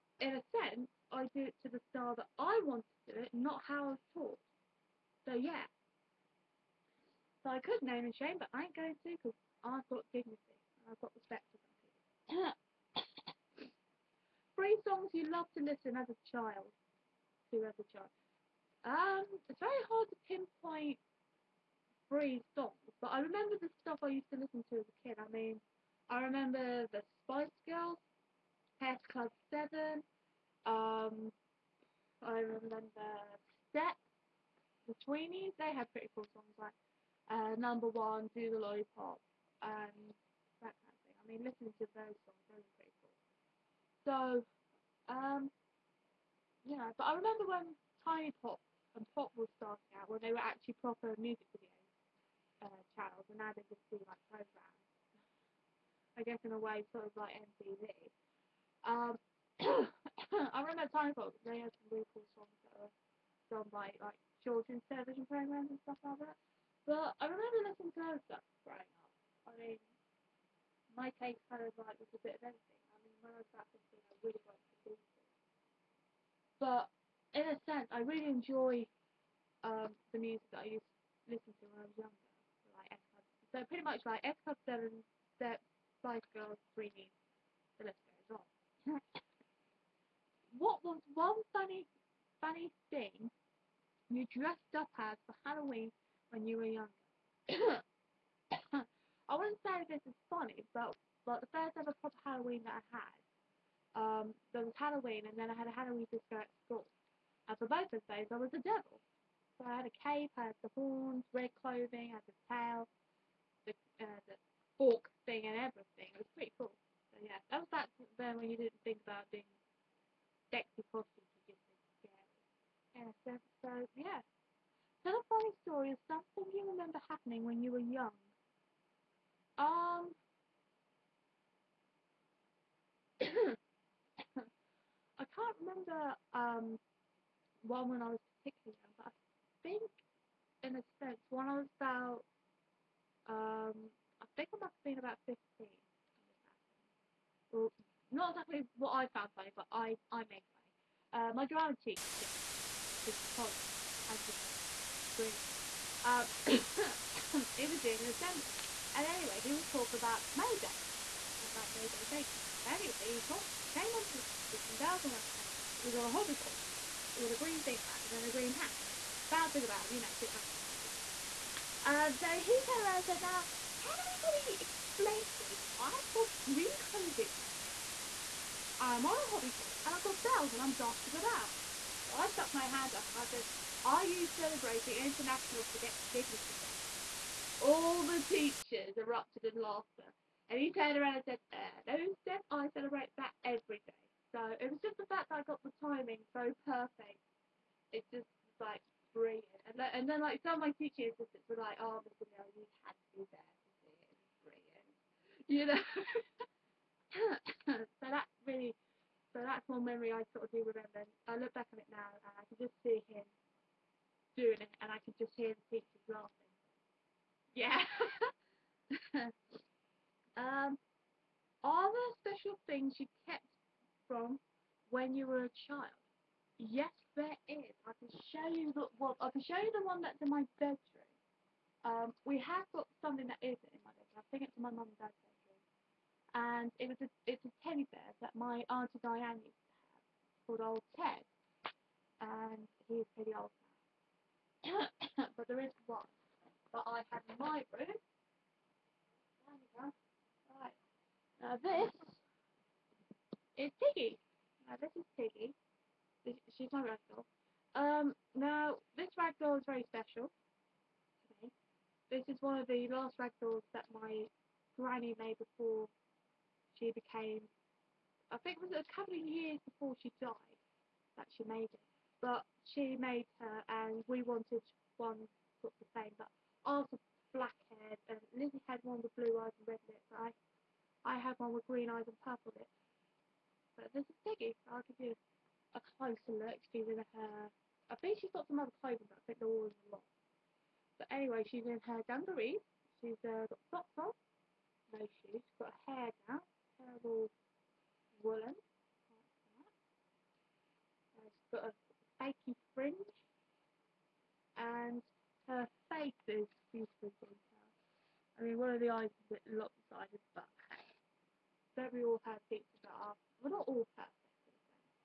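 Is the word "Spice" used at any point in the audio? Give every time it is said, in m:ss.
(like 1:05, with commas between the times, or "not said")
0:27, 1:26.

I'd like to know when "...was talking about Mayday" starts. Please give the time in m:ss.
2:39.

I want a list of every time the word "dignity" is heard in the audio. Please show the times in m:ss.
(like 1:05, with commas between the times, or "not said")
0:10, 3:06.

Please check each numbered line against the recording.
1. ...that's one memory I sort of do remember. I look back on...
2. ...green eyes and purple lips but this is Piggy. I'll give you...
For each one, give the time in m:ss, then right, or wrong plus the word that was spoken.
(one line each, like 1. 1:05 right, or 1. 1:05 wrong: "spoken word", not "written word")
1. 3:29 right
2. 4:41 right.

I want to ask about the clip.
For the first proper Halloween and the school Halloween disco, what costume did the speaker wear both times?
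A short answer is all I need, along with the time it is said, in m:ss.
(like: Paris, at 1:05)
Devil, at 1:48.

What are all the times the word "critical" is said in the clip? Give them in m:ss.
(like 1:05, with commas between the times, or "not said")
not said.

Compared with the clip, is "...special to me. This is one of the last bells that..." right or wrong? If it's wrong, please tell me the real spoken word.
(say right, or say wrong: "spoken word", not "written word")
wrong: "ragdolls", not "bells".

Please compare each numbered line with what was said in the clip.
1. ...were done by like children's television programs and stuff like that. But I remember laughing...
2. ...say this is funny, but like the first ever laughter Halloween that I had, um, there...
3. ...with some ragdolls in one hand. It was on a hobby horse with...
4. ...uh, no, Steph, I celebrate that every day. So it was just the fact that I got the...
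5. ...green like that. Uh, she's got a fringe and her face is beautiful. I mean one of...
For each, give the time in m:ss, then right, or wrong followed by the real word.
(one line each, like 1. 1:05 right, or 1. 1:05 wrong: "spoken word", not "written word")
1. 1:02 wrong: "listening", not "laughing"
2. 1:39 wrong: "proper", not "laughter"
3. 2:44 wrong: "bells", not "ragdolls"
4. 3:11 right
5. 4:58 wrong: "woolen", not "green".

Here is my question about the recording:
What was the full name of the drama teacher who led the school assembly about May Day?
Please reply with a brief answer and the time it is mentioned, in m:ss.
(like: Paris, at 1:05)
Andrew Colley, at 2:34.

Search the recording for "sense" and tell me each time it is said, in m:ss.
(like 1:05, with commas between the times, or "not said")
0:00, 1:17, 2:20.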